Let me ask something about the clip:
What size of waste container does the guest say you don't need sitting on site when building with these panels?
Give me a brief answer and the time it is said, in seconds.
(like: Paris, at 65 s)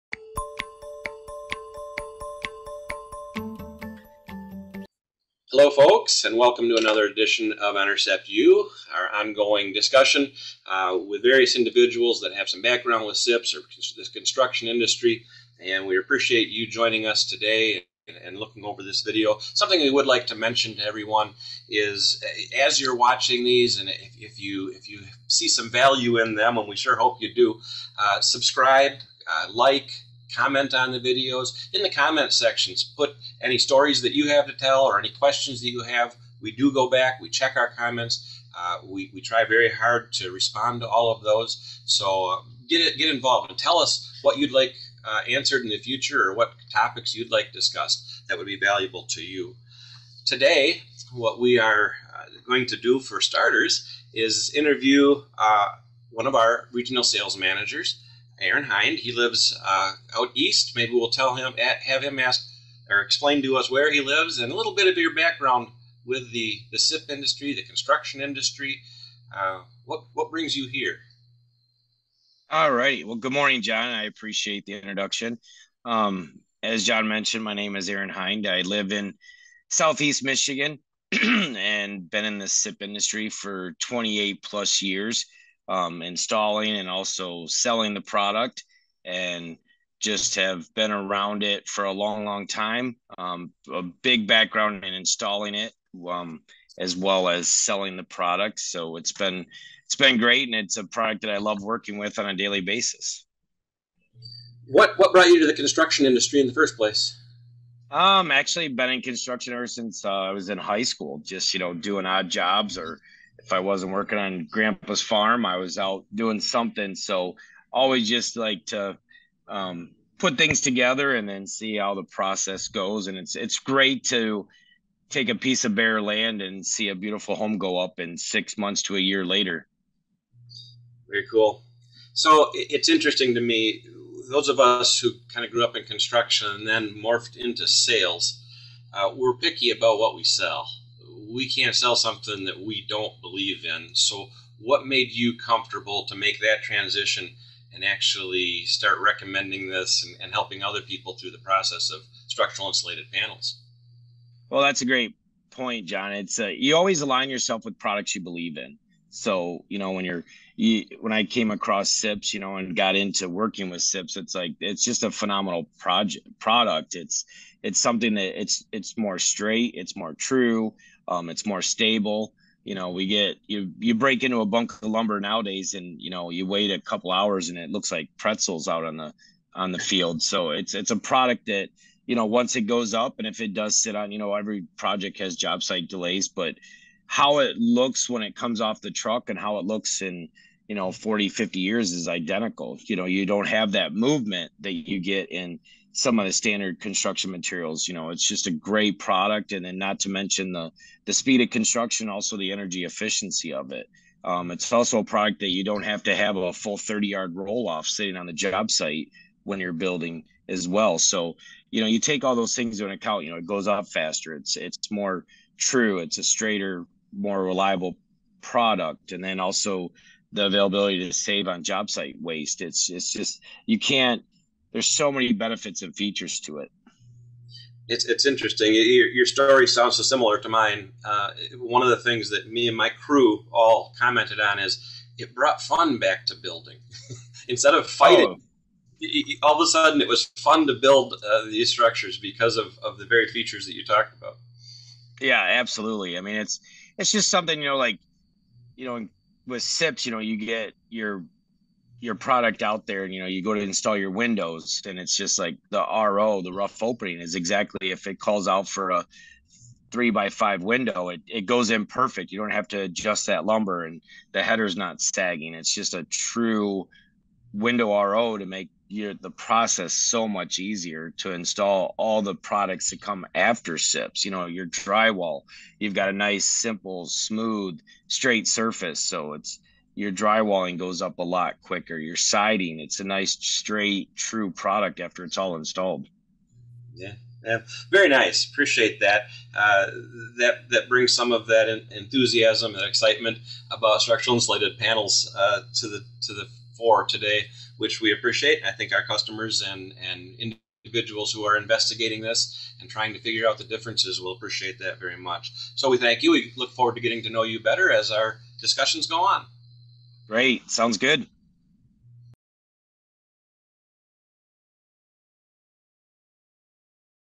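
30 yard roll off, at 206 s.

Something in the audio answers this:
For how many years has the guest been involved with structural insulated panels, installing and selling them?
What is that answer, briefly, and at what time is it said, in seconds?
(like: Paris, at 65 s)
28, at 83 s.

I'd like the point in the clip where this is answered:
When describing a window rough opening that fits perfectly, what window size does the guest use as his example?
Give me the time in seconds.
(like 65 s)
259 s.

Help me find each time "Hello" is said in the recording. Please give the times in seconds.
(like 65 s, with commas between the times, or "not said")
5 s.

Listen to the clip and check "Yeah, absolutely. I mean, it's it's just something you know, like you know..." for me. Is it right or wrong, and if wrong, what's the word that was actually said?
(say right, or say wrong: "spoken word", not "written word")
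right.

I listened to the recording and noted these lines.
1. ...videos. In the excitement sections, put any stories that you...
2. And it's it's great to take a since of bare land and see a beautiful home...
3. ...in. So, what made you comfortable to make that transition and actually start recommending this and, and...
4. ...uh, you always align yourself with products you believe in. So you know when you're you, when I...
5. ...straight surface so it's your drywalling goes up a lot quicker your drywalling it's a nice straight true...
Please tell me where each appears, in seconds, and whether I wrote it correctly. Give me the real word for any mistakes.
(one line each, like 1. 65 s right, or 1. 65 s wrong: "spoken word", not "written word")
1. 30 s wrong: "comment", not "excitement"
2. 123 s wrong: "piece", not "since"
3. 143 s right
4. 156 s right
5. 278 s wrong: "siding", not "drywalling".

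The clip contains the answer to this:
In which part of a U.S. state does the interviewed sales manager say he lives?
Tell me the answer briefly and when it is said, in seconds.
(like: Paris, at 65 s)
Southeast Michigan, at 79 s.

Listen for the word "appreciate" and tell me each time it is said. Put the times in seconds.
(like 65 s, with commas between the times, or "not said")
15 s, 74 s, 288 s, 298 s, 304 s.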